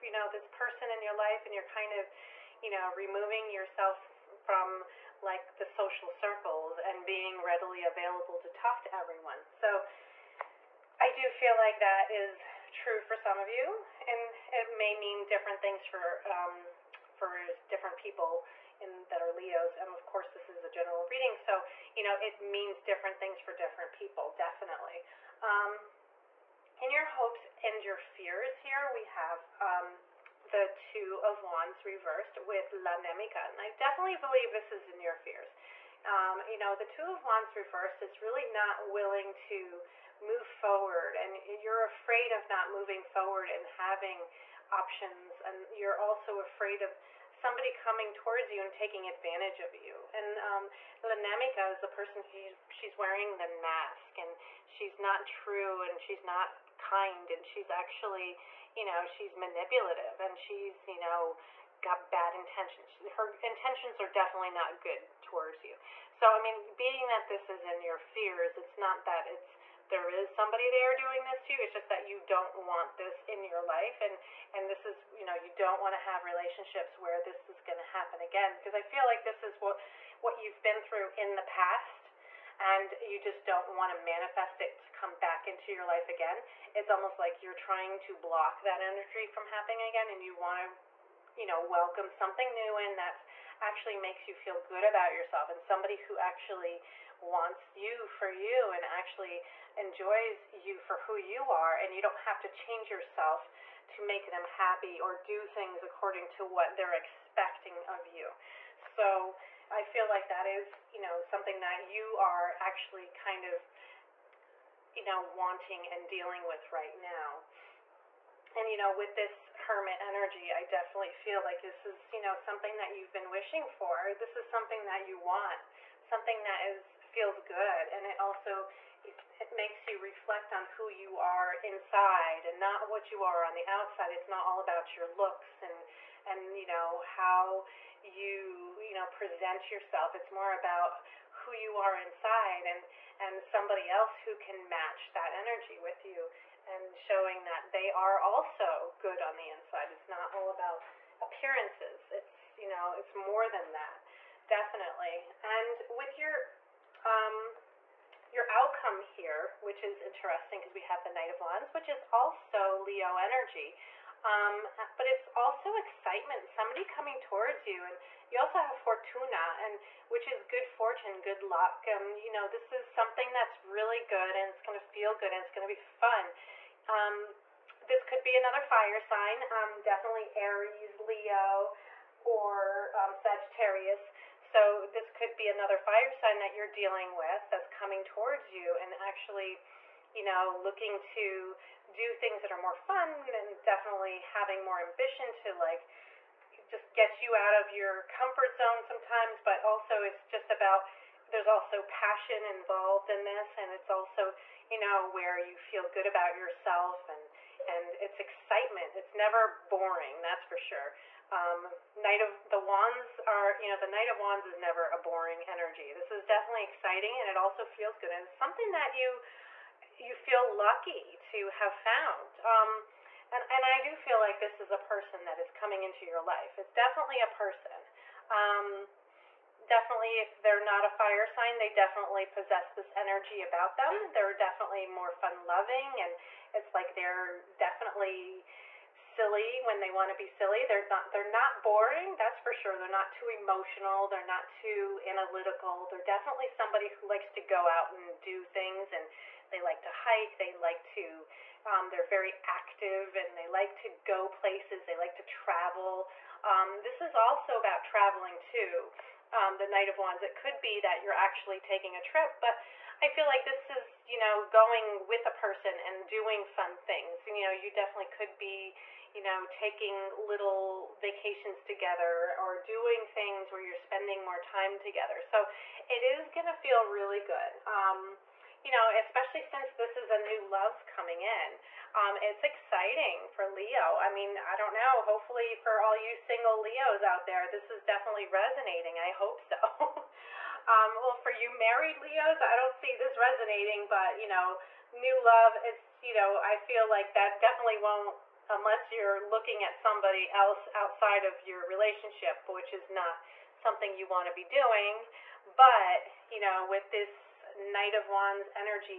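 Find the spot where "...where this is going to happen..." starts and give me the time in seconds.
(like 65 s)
76 s.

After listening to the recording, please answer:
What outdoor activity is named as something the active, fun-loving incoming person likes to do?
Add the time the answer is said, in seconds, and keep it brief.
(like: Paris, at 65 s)
Hike, at 249 s.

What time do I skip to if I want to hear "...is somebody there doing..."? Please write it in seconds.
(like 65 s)
70 s.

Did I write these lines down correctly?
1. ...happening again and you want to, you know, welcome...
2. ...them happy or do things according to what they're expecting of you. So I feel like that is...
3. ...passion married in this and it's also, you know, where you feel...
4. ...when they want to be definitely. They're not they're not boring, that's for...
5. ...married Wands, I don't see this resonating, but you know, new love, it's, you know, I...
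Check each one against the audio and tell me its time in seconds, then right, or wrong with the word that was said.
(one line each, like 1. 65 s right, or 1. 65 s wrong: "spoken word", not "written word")
1. 89 s right
2. 104 s right
3. 201 s wrong: "involved", not "married"
4. 239 s wrong: "silly", not "definitely"
5. 291 s wrong: "Leos", not "Wands".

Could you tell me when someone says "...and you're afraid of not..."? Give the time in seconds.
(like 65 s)
41 s.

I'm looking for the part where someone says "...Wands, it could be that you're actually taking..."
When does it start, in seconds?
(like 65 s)
259 s.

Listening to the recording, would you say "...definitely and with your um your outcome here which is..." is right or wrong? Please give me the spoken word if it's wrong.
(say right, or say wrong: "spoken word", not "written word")
right.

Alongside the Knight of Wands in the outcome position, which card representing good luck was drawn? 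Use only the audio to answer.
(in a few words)
Fortuna.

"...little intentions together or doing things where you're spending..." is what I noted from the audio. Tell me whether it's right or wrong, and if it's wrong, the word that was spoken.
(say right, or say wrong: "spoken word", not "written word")
wrong: "vacations", not "intentions".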